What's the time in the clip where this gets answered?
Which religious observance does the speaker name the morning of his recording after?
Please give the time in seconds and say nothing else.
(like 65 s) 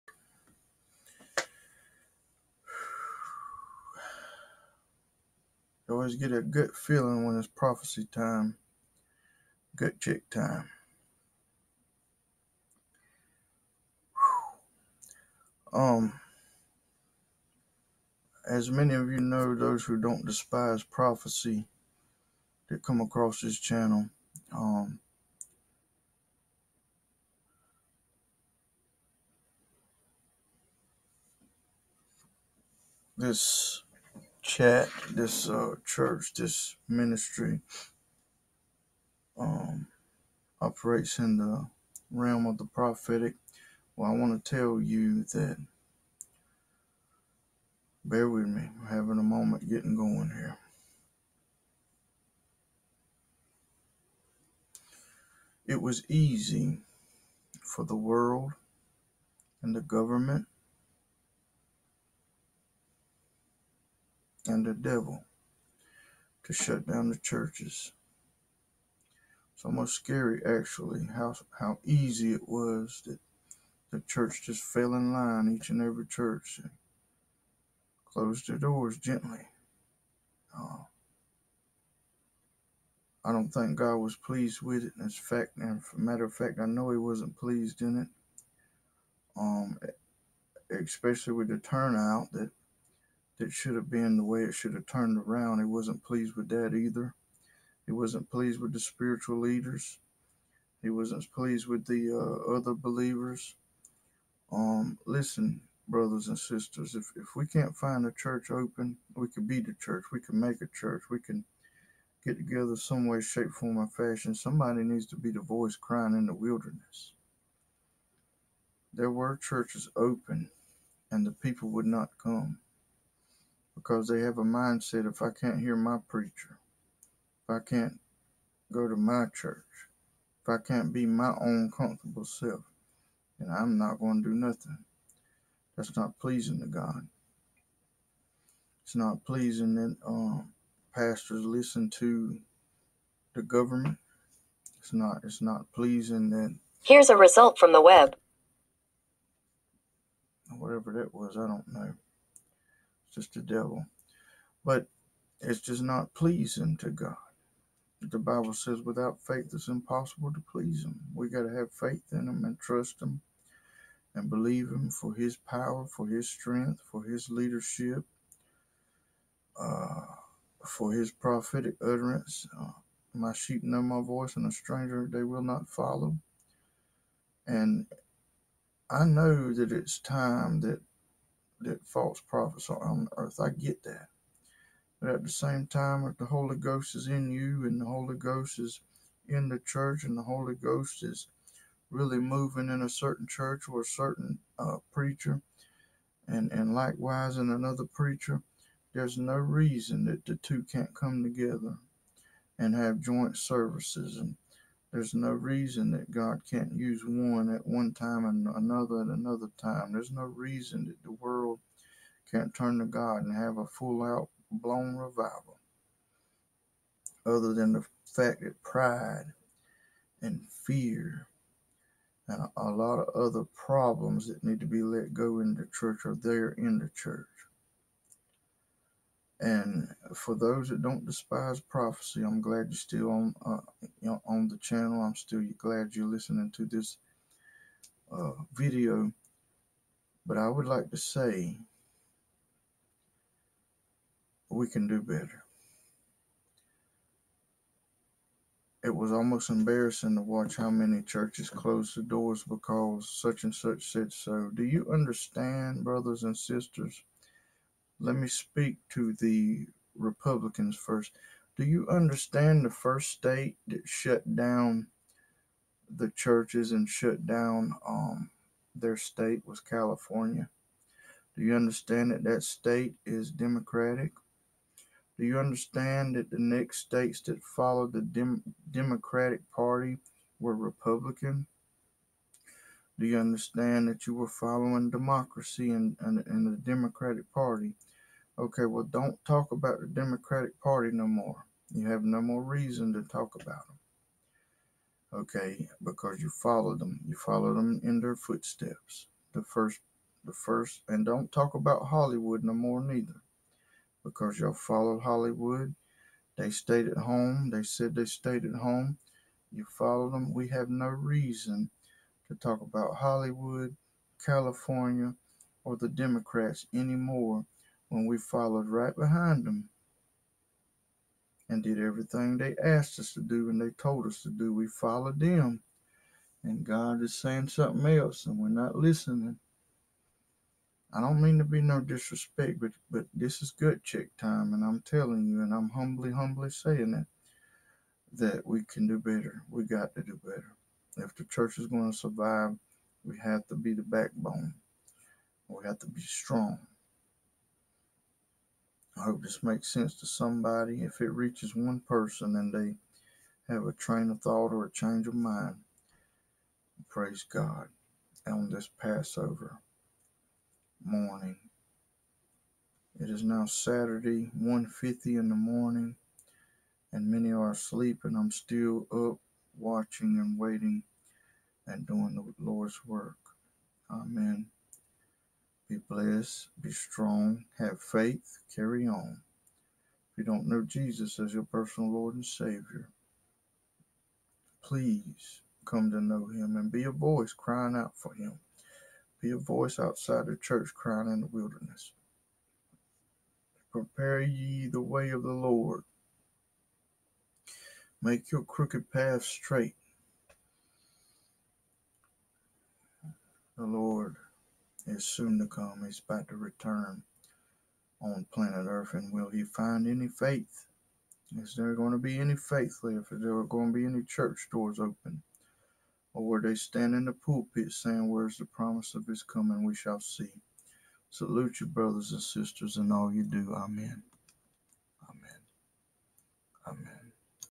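358 s.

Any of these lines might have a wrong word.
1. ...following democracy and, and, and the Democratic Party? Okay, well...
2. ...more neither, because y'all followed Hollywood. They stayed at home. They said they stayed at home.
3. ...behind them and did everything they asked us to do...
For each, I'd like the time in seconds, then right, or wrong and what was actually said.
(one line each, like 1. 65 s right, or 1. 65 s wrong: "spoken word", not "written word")
1. 284 s right
2. 302 s right
3. 318 s right.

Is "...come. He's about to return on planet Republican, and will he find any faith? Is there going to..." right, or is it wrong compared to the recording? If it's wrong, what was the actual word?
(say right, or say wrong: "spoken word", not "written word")
wrong: "Earth", not "Republican".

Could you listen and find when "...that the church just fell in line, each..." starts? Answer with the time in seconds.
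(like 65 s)
73 s.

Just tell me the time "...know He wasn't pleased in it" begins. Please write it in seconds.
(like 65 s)
86 s.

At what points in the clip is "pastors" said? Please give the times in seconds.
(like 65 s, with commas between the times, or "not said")
140 s.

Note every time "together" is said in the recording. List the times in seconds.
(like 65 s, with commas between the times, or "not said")
112 s, 201 s.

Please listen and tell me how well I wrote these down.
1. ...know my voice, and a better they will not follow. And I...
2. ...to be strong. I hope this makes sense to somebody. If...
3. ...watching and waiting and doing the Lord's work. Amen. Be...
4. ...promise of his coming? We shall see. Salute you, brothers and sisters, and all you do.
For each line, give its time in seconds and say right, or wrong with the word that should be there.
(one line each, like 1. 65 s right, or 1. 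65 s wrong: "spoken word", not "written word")
1. 173 s wrong: "stranger", not "better"
2. 345 s right
3. 369 s right
4. 418 s right.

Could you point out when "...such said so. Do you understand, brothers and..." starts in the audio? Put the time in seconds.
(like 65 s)
253 s.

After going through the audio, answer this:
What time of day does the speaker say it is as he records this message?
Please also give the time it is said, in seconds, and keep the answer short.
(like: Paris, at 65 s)
1:50 in the morning, at 364 s.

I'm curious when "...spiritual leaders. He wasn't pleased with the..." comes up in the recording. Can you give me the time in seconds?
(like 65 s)
98 s.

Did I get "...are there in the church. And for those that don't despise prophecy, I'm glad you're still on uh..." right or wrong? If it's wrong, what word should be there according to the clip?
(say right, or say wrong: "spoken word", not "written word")
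right.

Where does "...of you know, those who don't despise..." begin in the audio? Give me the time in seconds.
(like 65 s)
18 s.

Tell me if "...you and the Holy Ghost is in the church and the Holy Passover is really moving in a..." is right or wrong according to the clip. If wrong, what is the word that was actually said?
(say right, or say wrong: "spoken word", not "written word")
wrong: "Ghost", not "Passover".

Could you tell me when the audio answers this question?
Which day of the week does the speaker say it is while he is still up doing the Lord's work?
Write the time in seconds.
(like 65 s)
363 s.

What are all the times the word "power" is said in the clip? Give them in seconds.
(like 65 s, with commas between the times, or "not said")
165 s.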